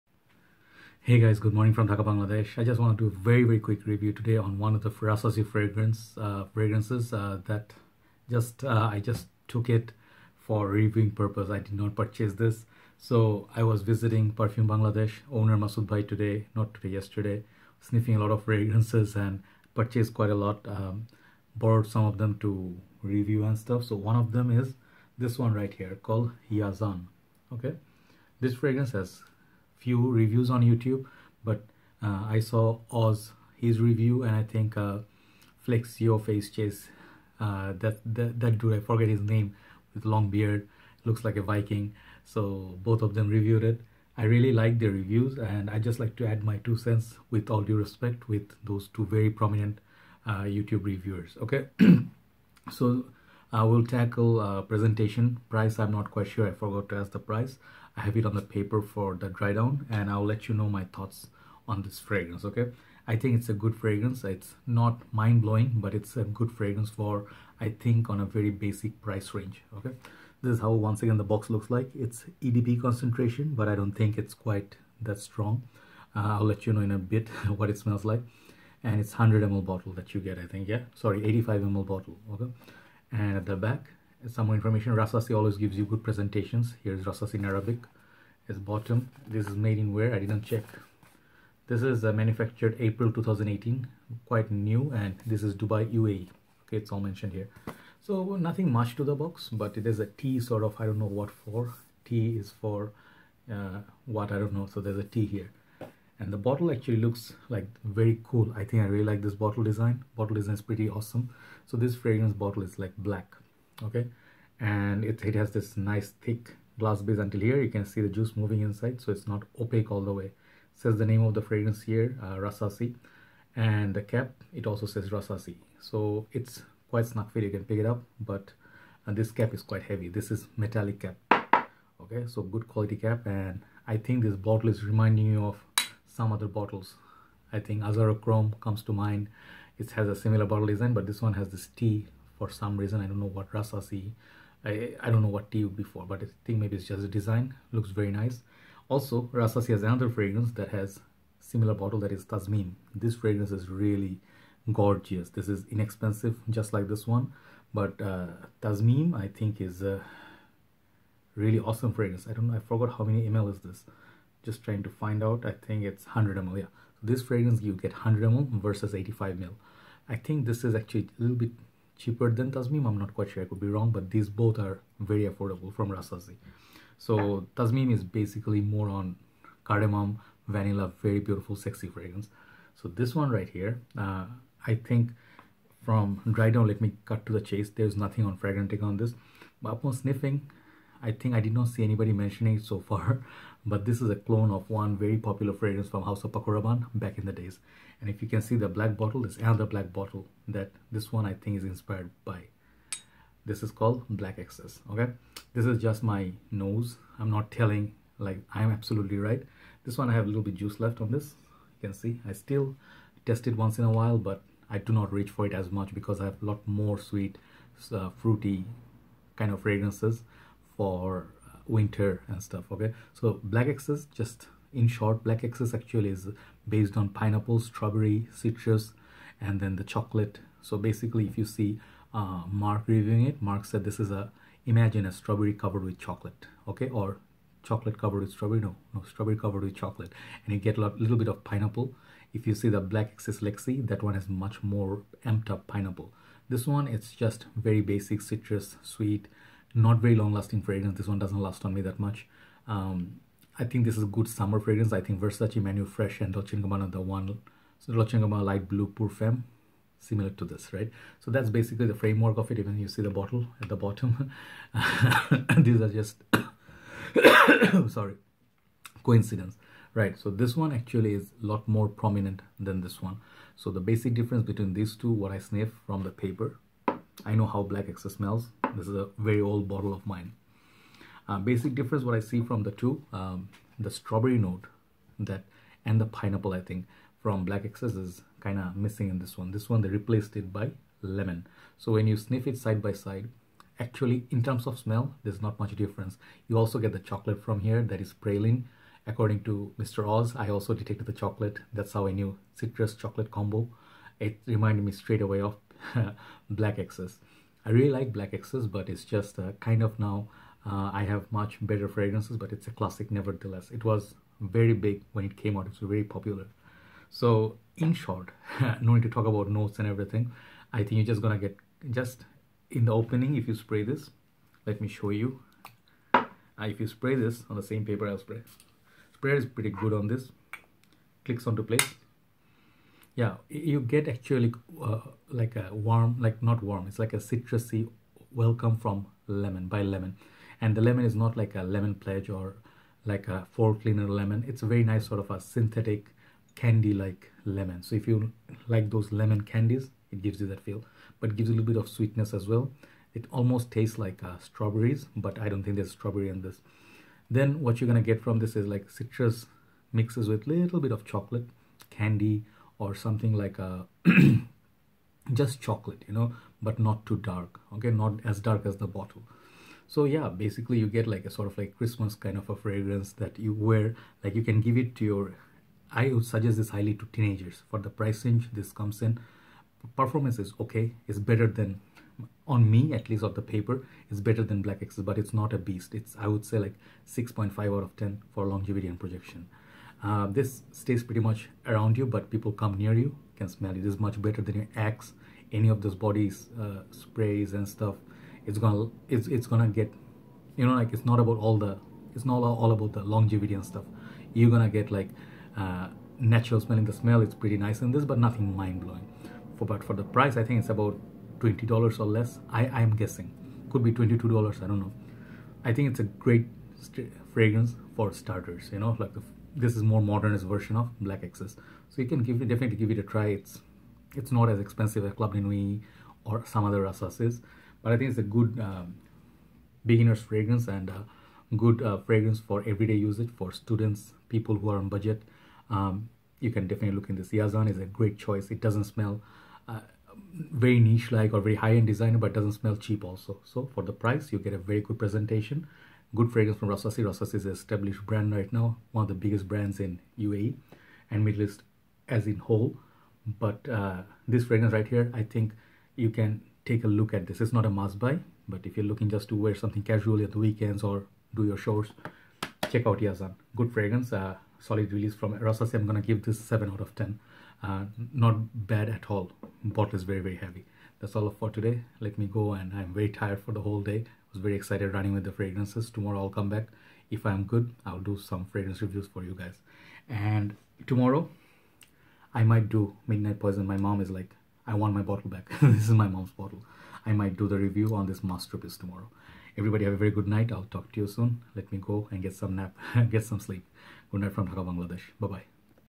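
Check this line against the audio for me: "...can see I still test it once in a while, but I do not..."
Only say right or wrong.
right.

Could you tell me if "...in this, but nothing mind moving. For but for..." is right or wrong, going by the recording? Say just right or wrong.
wrong.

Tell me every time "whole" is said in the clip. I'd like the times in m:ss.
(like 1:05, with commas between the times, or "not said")
7:32, 7:53.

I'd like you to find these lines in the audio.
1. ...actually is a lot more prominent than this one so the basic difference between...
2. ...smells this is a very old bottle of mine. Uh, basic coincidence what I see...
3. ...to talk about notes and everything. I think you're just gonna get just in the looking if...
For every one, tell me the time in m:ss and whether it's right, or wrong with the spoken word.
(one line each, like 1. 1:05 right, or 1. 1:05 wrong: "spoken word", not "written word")
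1. 4:30 right
2. 4:38 wrong: "difference", not "coincidence"
3. 5:19 wrong: "opening", not "looking".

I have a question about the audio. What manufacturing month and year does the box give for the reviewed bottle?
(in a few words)
April 2018.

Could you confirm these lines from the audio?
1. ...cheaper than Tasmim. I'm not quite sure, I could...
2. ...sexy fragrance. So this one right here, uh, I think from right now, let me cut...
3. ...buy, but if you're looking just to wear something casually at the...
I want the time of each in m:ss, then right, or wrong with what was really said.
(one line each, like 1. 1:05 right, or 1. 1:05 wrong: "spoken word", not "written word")
1. 2:52 right
2. 3:01 right
3. 7:37 right.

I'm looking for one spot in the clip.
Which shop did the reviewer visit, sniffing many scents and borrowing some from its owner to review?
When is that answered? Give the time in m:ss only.
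0:14.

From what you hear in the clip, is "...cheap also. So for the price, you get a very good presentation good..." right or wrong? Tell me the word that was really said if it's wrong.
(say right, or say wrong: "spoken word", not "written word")
right.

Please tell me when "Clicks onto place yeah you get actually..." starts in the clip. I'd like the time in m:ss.
5:31.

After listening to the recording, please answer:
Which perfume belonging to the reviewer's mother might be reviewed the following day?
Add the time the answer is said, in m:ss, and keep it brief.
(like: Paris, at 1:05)
Midnight Poison, at 8:03.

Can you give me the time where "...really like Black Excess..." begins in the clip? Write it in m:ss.
5:07.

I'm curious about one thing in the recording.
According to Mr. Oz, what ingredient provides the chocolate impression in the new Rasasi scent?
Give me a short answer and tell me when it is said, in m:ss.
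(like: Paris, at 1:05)
Praline, at 4:58.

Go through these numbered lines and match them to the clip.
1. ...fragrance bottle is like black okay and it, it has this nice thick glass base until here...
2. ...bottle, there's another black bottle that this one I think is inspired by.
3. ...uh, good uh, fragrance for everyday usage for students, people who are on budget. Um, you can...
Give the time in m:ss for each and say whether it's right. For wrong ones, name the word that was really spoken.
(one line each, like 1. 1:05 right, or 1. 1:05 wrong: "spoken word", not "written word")
1. 1:51 right
2. 3:18 right
3. 7:10 right.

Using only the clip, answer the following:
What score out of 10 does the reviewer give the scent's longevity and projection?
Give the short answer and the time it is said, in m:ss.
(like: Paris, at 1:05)
6.5, at 6:27.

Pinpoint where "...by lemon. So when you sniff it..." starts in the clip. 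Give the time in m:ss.
4:50.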